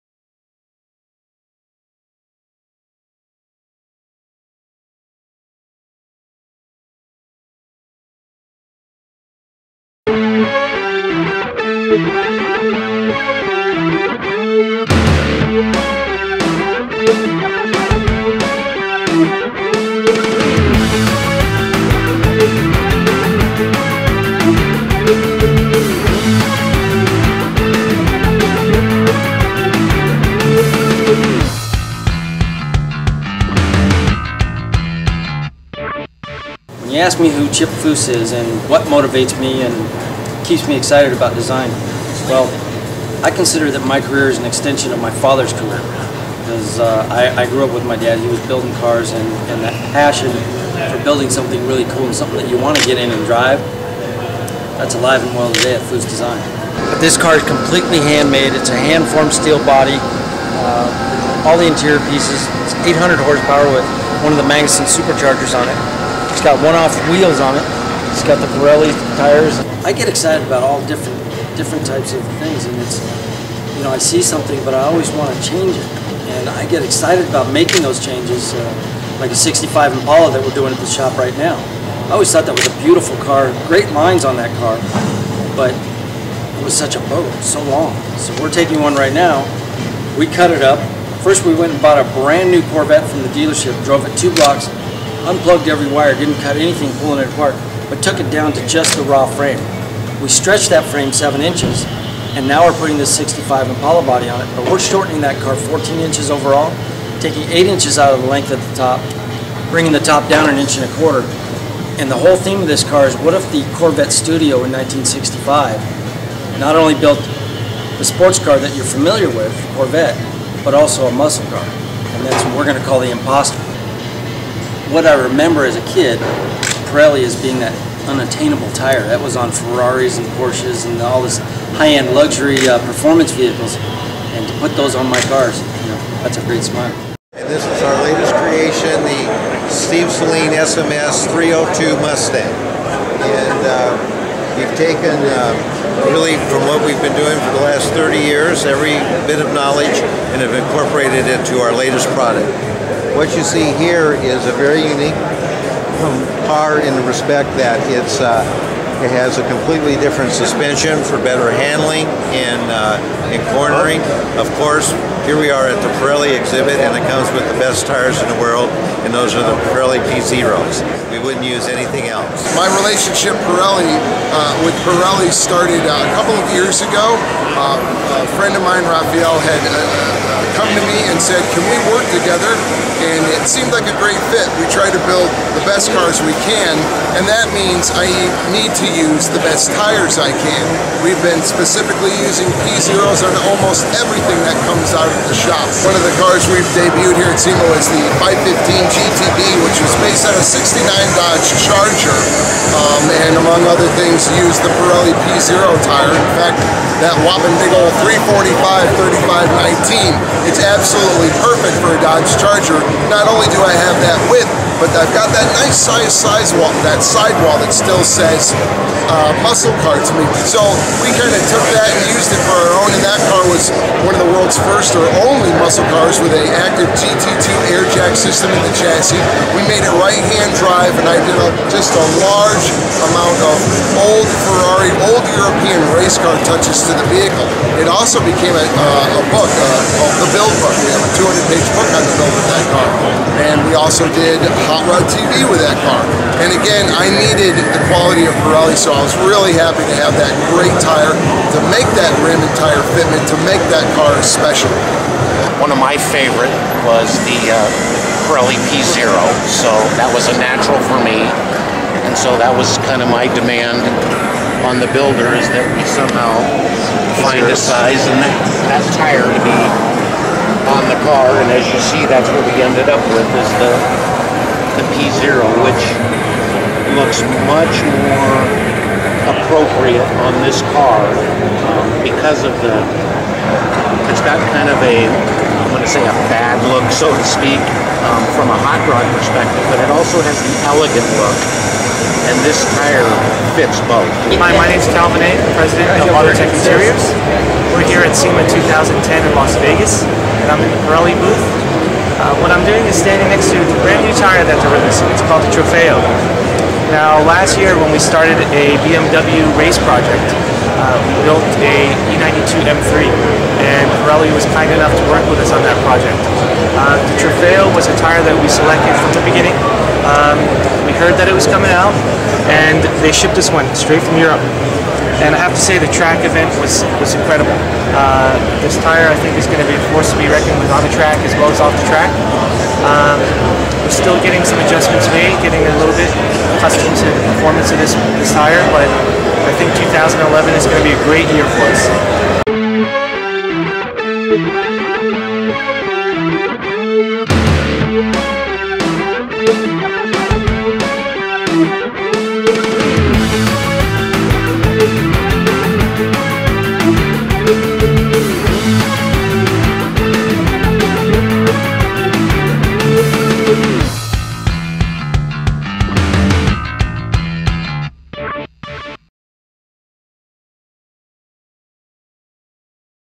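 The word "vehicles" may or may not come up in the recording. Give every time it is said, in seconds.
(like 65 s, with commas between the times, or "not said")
133 s, 237 s.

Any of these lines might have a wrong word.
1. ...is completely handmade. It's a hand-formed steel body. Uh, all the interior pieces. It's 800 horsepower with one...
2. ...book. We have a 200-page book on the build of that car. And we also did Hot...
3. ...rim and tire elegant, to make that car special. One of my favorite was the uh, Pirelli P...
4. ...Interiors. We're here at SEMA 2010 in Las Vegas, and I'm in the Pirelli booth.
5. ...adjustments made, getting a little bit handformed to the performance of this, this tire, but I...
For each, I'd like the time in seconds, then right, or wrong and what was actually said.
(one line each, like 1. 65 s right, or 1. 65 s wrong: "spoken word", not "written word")
1. 57 s right
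2. 240 s right
3. 252 s wrong: "fitment", not "elegant"
4. 296 s right
5. 334 s wrong: "accustomed", not "handformed".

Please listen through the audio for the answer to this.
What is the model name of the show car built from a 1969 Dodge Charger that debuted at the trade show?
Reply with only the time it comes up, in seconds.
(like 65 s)
198 s.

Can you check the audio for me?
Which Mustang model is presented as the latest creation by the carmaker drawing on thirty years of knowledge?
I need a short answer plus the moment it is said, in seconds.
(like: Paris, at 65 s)
SMS 302, at 140 s.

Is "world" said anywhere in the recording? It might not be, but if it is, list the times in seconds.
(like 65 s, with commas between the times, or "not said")
168 s, 224 s.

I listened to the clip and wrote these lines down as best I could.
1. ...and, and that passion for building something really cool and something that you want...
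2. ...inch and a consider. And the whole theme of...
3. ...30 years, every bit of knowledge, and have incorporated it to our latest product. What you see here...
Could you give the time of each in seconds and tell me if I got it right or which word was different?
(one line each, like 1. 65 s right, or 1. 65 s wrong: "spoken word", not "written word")
1. 49 s right
2. 110 s wrong: "quarter", not "consider"
3. 147 s right.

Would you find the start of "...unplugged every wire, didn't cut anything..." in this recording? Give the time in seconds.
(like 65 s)
95 s.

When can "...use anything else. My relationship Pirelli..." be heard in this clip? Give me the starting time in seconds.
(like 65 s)
171 s.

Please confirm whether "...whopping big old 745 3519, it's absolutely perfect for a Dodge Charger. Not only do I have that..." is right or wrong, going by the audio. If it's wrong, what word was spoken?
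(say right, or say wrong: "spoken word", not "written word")
wrong: "345", not "745".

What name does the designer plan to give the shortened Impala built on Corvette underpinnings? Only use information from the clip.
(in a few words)
The Imposter.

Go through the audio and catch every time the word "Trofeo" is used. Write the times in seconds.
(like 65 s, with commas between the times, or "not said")
305 s, 317 s.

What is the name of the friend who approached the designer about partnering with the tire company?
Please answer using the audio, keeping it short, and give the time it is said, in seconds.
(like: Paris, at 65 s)
Raphael, at 178 s.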